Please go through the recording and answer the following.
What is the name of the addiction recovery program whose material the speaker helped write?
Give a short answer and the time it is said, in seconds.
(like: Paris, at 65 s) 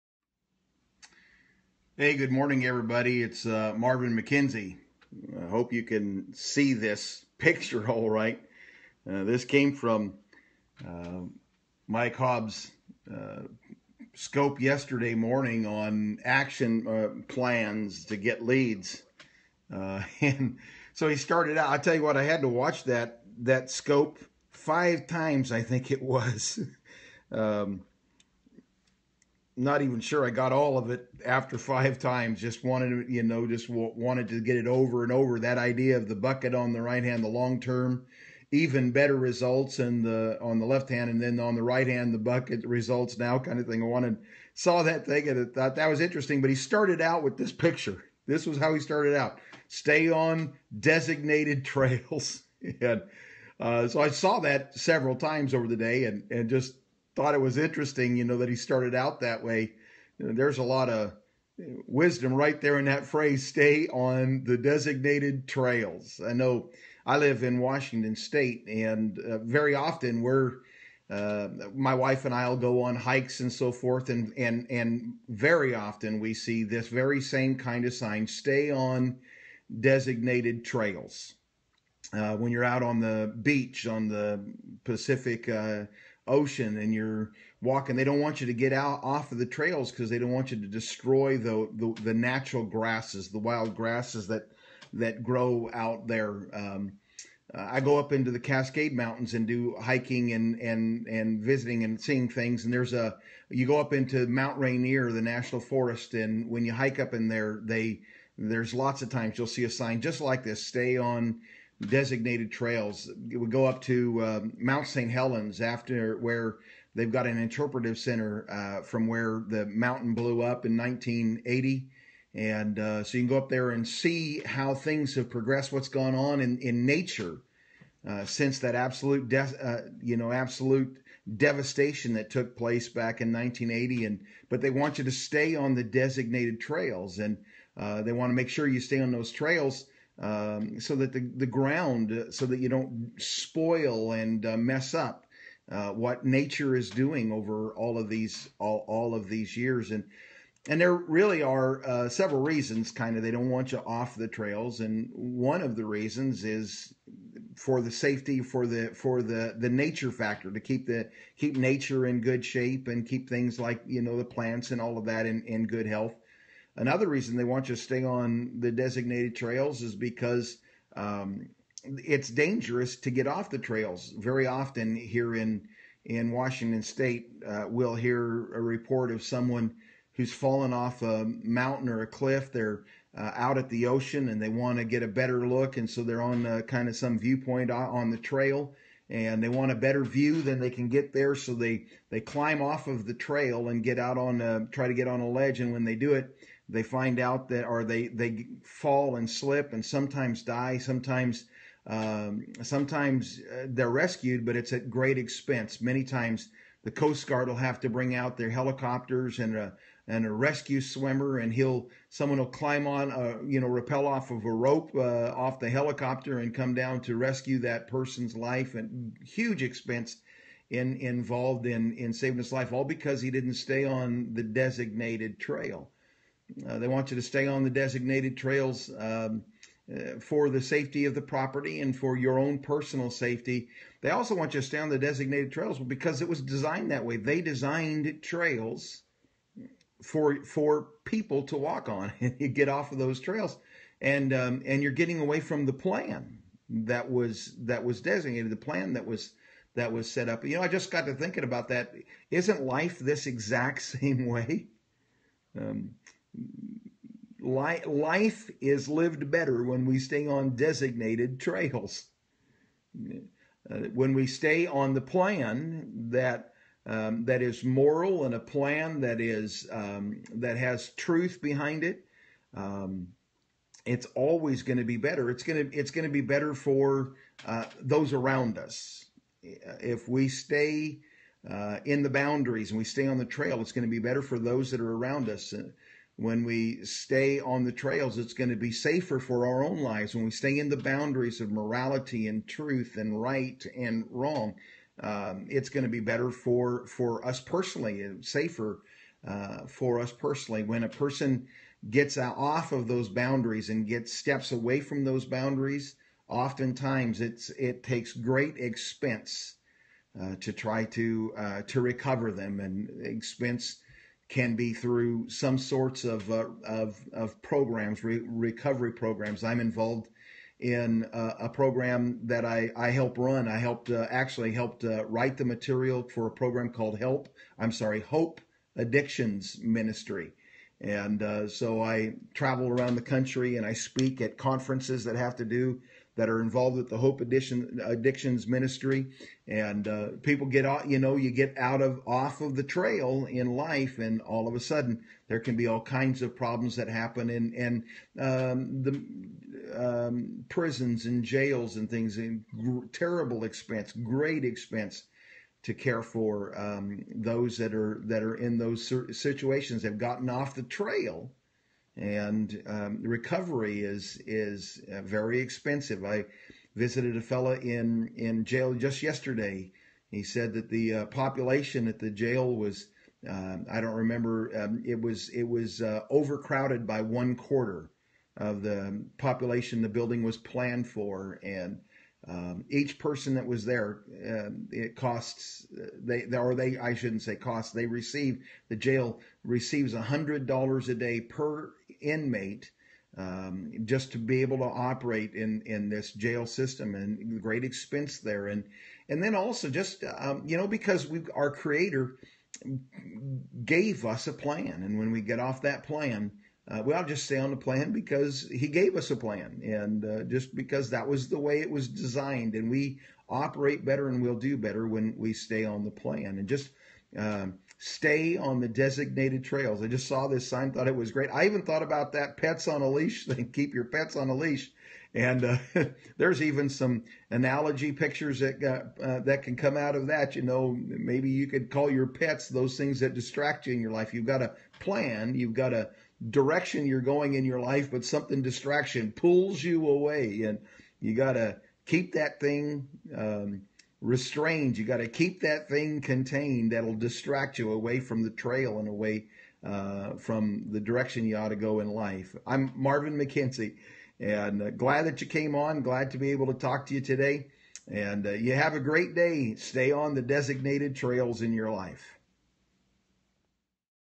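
Hope Addictions Ministry, at 327 s.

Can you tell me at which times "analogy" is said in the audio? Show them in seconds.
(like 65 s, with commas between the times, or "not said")
427 s.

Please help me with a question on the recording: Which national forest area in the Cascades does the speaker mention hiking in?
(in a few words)
Mount Rainier.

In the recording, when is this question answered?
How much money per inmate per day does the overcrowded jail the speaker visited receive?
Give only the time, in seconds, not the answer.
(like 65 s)
389 s.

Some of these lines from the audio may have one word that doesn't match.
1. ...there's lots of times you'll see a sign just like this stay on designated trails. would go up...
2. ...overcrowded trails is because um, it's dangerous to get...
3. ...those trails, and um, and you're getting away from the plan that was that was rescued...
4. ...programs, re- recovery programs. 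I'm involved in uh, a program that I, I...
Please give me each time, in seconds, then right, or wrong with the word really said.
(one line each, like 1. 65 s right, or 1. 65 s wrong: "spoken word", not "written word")
1. 108 s right
2. 168 s wrong: "designated", not "overcrowded"
3. 242 s wrong: "designated", not "rescued"
4. 317 s right.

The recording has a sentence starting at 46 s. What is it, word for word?
But he started out with this picture.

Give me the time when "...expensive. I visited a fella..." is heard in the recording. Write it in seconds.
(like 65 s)
365 s.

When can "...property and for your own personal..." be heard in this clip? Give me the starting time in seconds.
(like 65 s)
231 s.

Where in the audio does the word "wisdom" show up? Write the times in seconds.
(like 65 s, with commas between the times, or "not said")
61 s.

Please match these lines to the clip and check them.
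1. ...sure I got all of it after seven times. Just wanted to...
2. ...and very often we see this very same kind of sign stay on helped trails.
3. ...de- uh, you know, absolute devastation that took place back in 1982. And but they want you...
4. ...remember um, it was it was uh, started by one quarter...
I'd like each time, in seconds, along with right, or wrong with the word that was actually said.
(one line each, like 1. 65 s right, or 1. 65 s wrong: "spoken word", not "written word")
1. 29 s wrong: "five", not "seven"
2. 74 s wrong: "designated", not "helped"
3. 129 s wrong: "1980", not "1982"
4. 373 s wrong: "overcrowded", not "started".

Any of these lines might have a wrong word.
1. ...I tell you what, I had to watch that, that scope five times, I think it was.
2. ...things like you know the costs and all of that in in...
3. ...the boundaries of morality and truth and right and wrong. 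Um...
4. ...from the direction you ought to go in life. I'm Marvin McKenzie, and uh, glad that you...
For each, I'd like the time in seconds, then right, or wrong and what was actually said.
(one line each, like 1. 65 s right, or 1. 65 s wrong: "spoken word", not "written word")
1. 21 s right
2. 163 s wrong: "plants", not "costs"
3. 290 s right
4. 450 s right.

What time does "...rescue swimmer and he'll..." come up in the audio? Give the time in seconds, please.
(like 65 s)
210 s.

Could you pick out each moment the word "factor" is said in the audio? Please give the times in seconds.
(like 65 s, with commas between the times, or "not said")
160 s.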